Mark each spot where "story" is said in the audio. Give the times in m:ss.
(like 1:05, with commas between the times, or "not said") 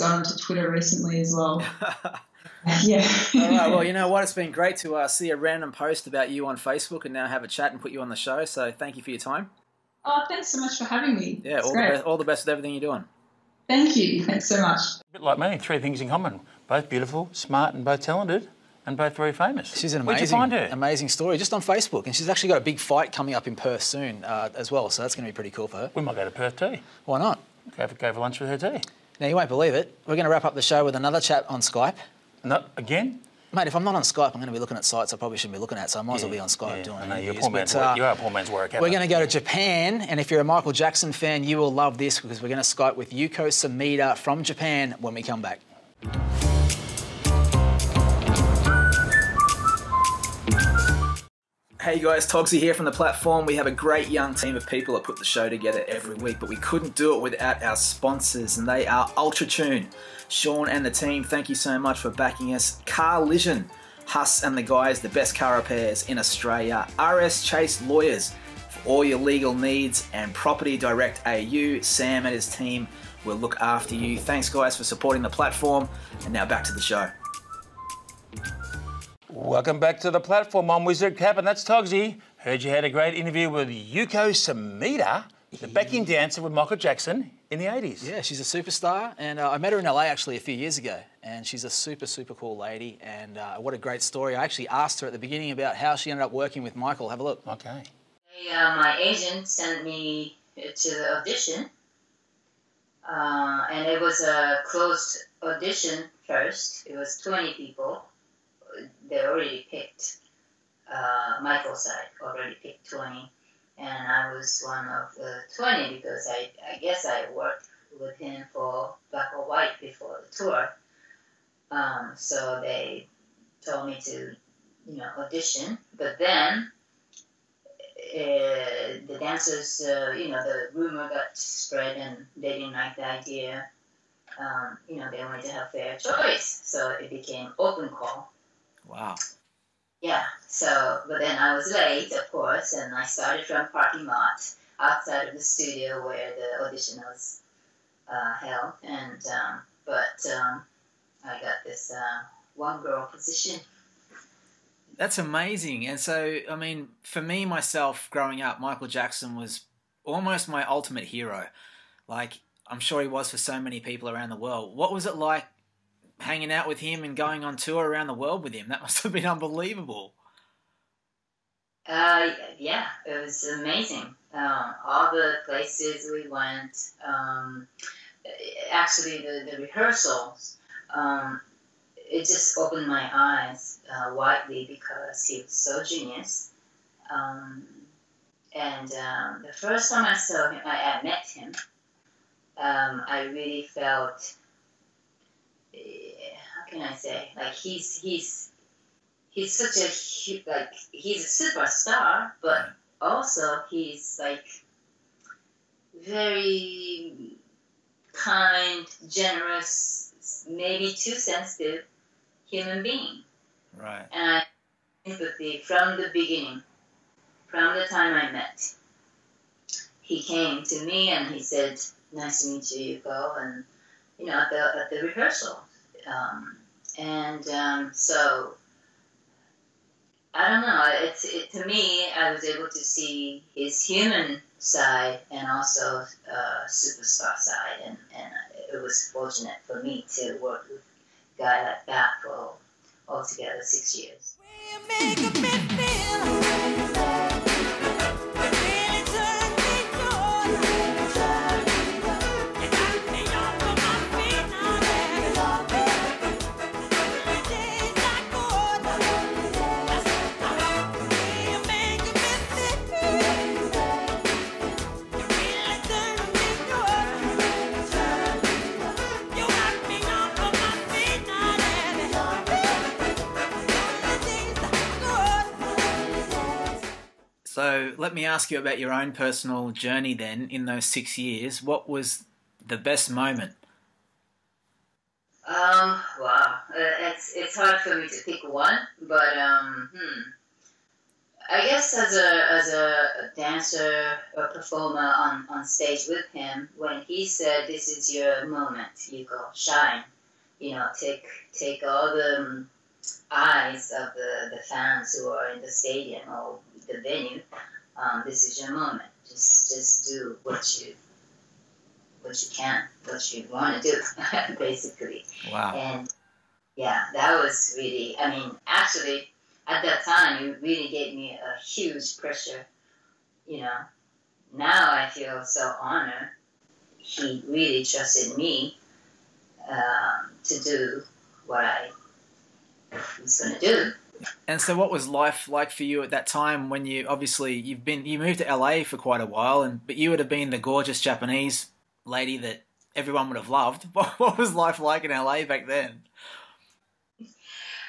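0:21, 1:34.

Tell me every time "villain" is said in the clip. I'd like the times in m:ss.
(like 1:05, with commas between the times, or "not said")
not said.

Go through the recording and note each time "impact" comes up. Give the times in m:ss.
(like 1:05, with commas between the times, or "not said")
not said.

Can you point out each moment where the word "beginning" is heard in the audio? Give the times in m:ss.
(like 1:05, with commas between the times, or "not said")
1:35, 3:36.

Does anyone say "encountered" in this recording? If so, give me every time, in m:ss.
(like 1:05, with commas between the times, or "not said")
not said.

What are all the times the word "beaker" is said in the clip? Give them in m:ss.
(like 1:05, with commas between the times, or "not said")
not said.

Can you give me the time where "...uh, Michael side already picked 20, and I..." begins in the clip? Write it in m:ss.
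1:50.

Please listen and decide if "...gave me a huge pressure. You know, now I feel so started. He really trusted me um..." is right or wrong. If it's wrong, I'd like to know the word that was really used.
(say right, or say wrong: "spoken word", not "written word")
wrong: "honored", not "started".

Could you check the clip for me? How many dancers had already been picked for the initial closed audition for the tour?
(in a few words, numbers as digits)
20.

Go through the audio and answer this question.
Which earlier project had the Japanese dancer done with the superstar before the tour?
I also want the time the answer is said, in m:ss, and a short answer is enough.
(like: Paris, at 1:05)
Black or White, at 1:59.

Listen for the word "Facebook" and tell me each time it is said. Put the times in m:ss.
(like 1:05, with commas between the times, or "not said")
0:06, 0:21.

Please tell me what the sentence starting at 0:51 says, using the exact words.
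Hey guys, Toggsy here from the platform.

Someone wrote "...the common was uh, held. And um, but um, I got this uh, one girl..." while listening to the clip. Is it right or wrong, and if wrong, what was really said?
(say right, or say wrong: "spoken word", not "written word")
wrong: "audition", not "common".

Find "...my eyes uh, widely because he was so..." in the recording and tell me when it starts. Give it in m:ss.
3:02.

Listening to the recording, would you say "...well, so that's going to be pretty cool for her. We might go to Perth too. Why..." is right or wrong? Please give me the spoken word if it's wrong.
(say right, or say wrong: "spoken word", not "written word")
right.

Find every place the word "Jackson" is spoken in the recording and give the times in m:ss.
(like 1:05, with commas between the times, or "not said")
0:40, 1:26, 2:38.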